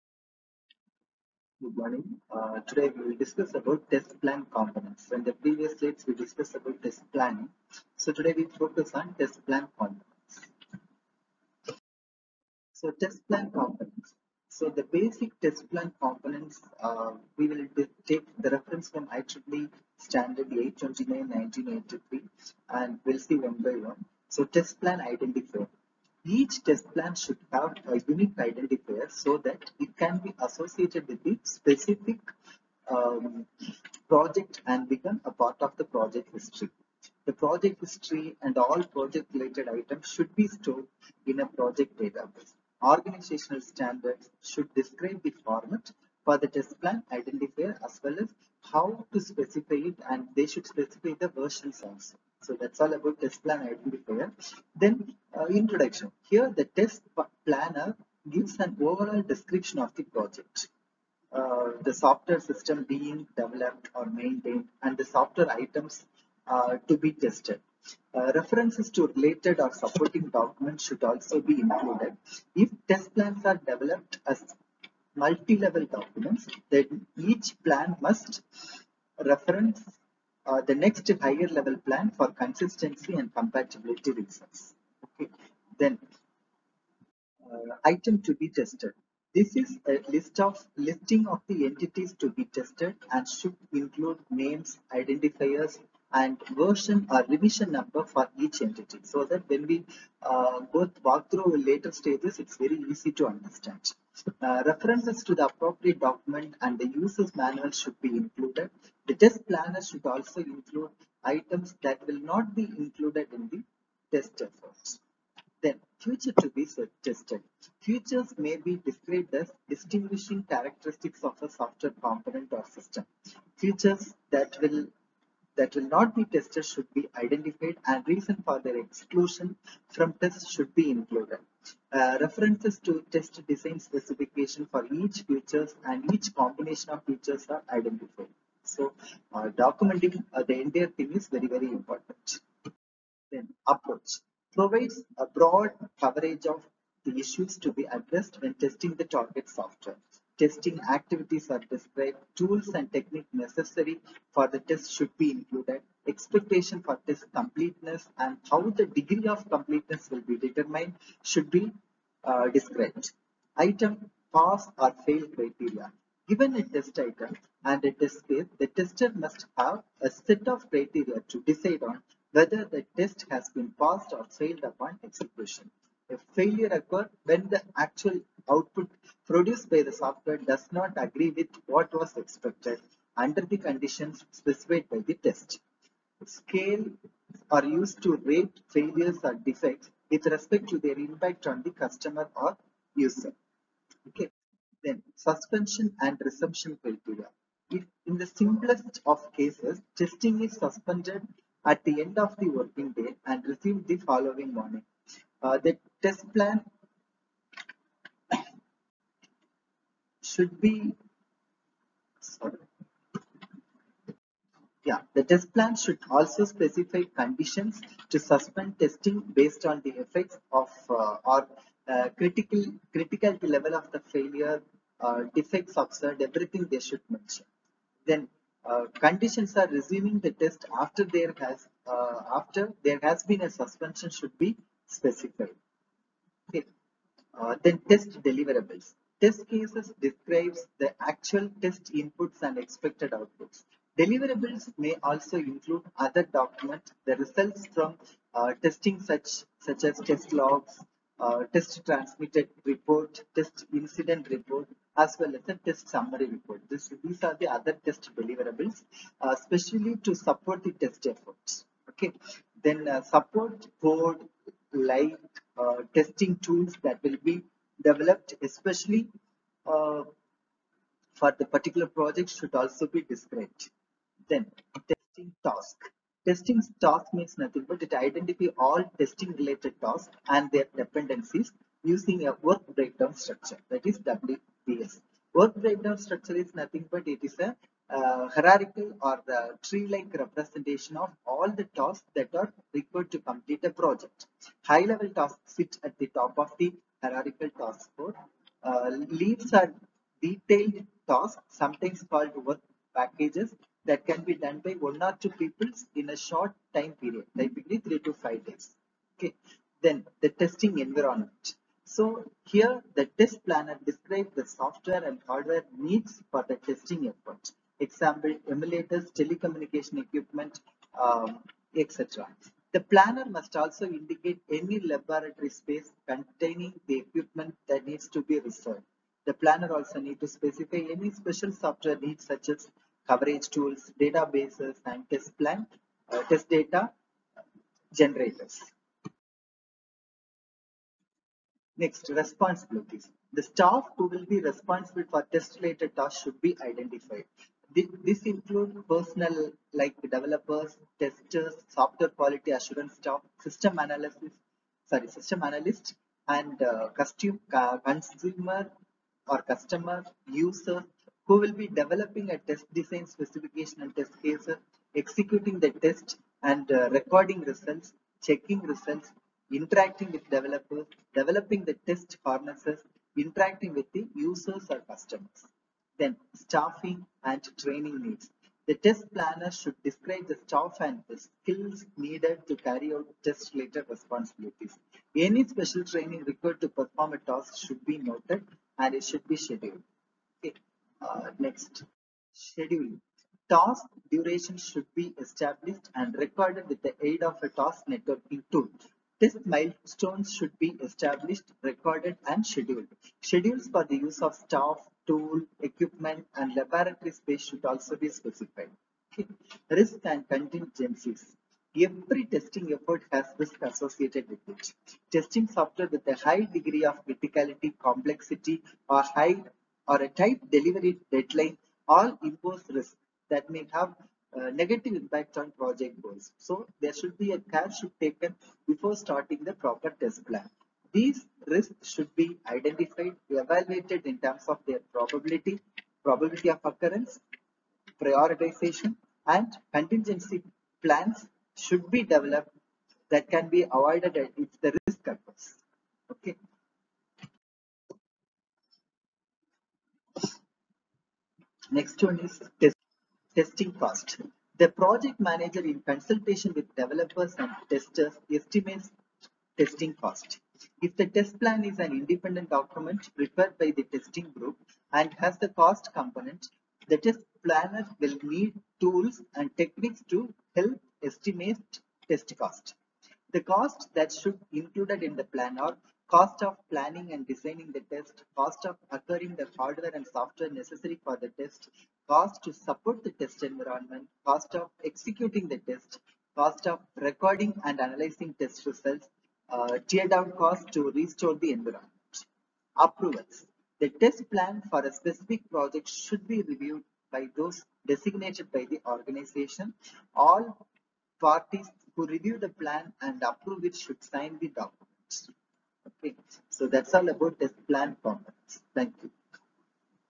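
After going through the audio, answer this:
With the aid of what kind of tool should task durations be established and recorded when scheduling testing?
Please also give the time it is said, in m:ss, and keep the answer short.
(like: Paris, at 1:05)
task networking tool, at 6:37.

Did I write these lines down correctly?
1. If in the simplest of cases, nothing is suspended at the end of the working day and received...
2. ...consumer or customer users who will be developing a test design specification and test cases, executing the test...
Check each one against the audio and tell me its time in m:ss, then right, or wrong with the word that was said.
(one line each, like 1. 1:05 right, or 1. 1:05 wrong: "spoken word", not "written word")
1. 3:17 wrong: "testing", not "nothing"
2. 5:57 right.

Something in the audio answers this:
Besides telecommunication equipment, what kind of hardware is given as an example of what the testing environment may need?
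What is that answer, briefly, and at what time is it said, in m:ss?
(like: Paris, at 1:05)
emulators, at 5:18.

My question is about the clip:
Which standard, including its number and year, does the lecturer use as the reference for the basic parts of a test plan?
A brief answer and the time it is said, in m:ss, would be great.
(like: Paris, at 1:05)
IEEE 829-1983, at 0:19.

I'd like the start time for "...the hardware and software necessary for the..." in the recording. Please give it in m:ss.
7:59.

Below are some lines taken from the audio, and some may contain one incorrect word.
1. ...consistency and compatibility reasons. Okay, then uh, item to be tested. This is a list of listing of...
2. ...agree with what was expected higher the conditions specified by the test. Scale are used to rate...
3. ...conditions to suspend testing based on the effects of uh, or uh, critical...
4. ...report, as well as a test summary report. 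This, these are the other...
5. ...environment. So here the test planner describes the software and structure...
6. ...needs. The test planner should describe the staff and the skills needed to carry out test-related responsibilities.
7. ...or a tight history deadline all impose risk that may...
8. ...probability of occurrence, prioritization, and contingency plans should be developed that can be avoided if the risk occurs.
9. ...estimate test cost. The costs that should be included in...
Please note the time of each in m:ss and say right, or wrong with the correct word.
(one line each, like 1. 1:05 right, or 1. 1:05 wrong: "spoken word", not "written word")
1. 1:22 right
2. 3:01 wrong: "under", not "higher"
3. 3:37 right
4. 4:14 right
5. 5:10 wrong: "hardware", not "structure"
6. 6:18 right
7. 6:59 wrong: "delivery", not "history"
8. 7:16 right
9. 7:51 right.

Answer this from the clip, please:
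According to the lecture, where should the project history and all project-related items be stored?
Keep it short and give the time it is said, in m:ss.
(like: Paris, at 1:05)
project database, at 0:41.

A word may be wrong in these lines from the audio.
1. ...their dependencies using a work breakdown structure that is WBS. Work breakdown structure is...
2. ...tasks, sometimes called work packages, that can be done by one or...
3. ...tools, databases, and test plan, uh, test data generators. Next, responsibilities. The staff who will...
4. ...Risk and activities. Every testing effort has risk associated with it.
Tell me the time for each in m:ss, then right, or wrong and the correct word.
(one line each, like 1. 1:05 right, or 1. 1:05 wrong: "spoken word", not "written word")
1. 4:40 right
2. 5:01 right
3. 5:33 right
4. 6:49 wrong: "contingencies", not "activities".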